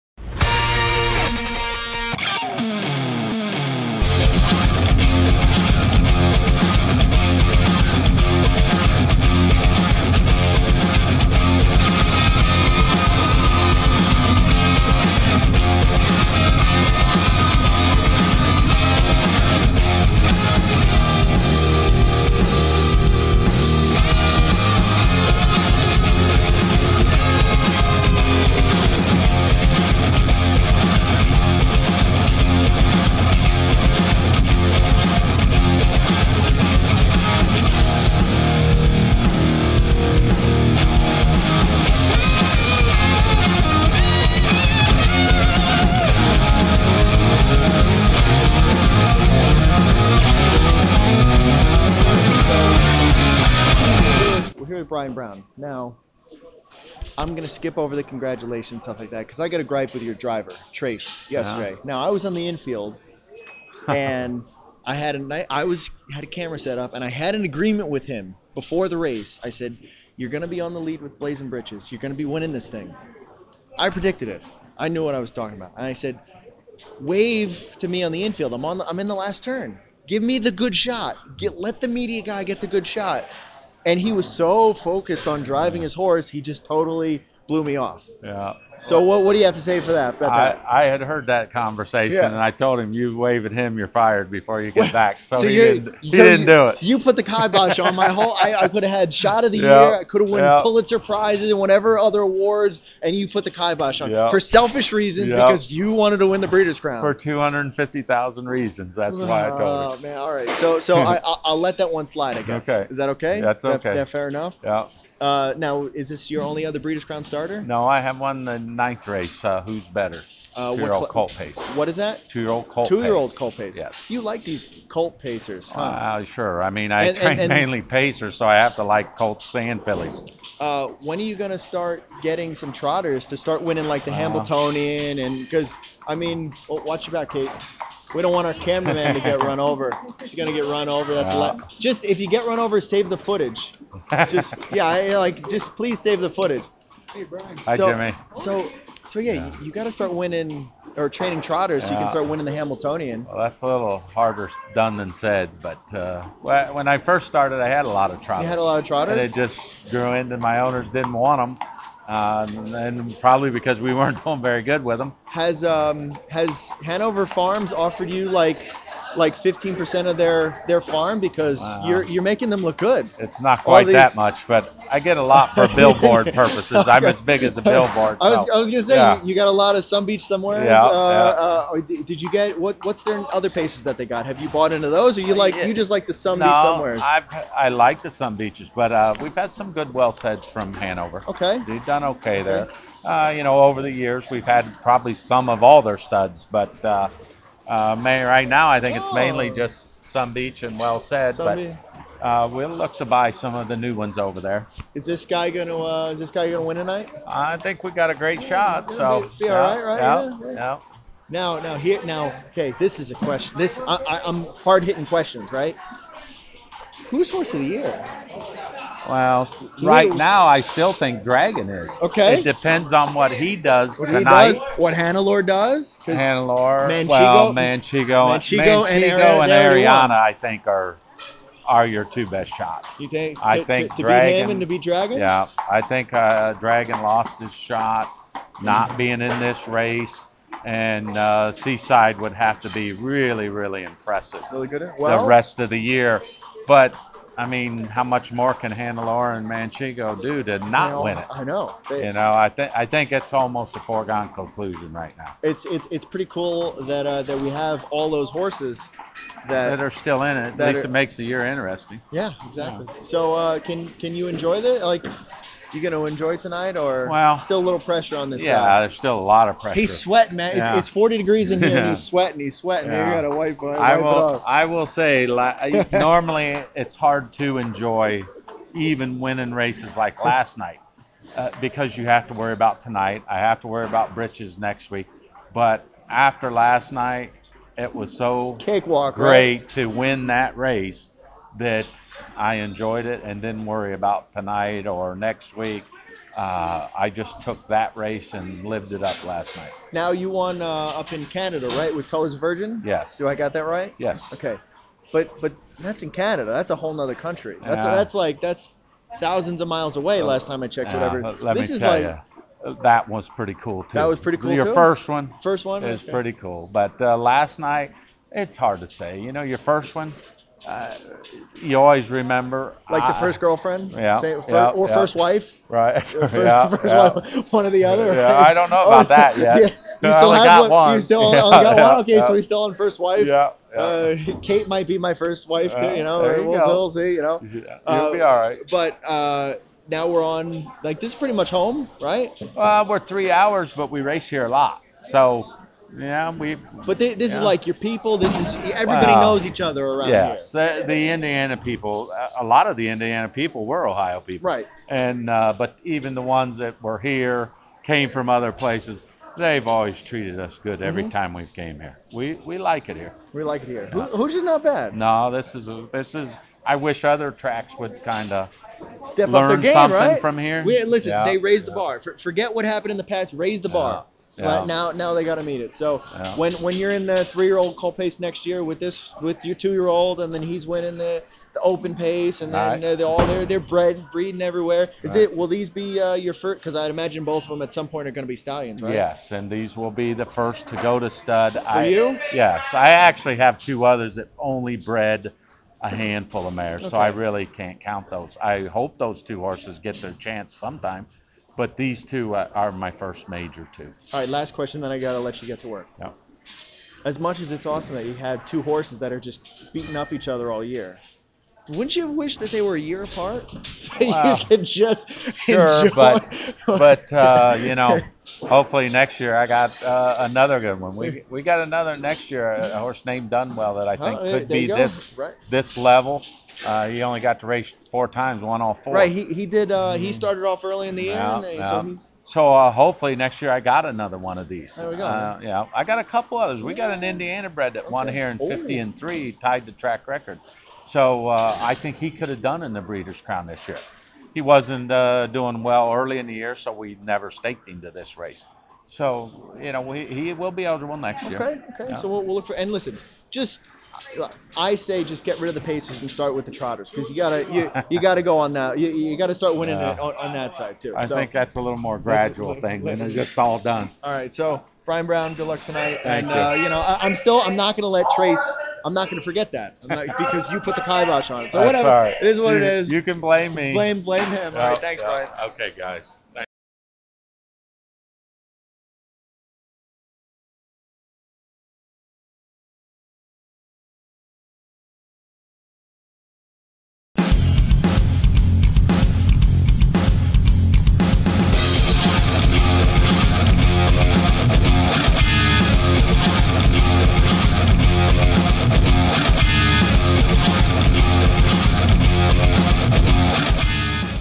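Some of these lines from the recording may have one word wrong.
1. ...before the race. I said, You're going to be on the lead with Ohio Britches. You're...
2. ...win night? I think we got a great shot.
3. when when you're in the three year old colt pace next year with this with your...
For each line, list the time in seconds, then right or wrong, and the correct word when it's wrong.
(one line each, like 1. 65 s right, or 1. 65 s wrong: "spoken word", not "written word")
1. 68 s wrong: "Blazin", not "Ohio"
2. 206 s wrong: "tonight", not "night"
3. 376 s right.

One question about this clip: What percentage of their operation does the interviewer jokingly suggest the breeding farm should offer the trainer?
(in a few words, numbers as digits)
15%.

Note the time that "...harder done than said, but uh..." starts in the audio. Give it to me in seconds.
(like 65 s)
153 s.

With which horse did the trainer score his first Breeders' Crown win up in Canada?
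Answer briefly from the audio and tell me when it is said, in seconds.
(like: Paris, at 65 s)
Colors Virgin, at 302 s.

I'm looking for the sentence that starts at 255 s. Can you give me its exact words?
It's it's, it's pretty cool that uh, that we have all those horses that, that are still in it.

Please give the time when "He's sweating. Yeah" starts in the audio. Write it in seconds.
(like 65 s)
272 s.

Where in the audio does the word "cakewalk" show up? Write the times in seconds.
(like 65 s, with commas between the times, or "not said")
288 s.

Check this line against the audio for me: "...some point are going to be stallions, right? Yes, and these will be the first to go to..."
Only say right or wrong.
right.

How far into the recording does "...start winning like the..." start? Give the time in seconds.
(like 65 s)
133 s.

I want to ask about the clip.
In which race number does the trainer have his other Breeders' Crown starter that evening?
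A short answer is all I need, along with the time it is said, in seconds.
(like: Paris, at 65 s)
Ninth race, at 118 s.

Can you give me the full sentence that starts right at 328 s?
i don't know about oh, that yet yeah.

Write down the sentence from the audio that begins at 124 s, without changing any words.
You like these colt pacers, huh?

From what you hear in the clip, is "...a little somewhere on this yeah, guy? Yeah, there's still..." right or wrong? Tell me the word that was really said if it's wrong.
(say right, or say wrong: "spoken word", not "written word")
wrong: "pressure", not "somewhere".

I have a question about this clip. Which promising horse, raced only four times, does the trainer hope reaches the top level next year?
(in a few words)
Dunwell.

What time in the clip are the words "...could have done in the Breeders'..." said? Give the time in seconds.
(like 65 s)
442 s.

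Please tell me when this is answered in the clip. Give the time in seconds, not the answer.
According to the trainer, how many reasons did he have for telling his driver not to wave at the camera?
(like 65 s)
107 s.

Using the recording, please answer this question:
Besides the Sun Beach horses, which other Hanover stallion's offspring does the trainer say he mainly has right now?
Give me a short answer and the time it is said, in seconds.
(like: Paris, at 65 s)
Well Said, at 200 s.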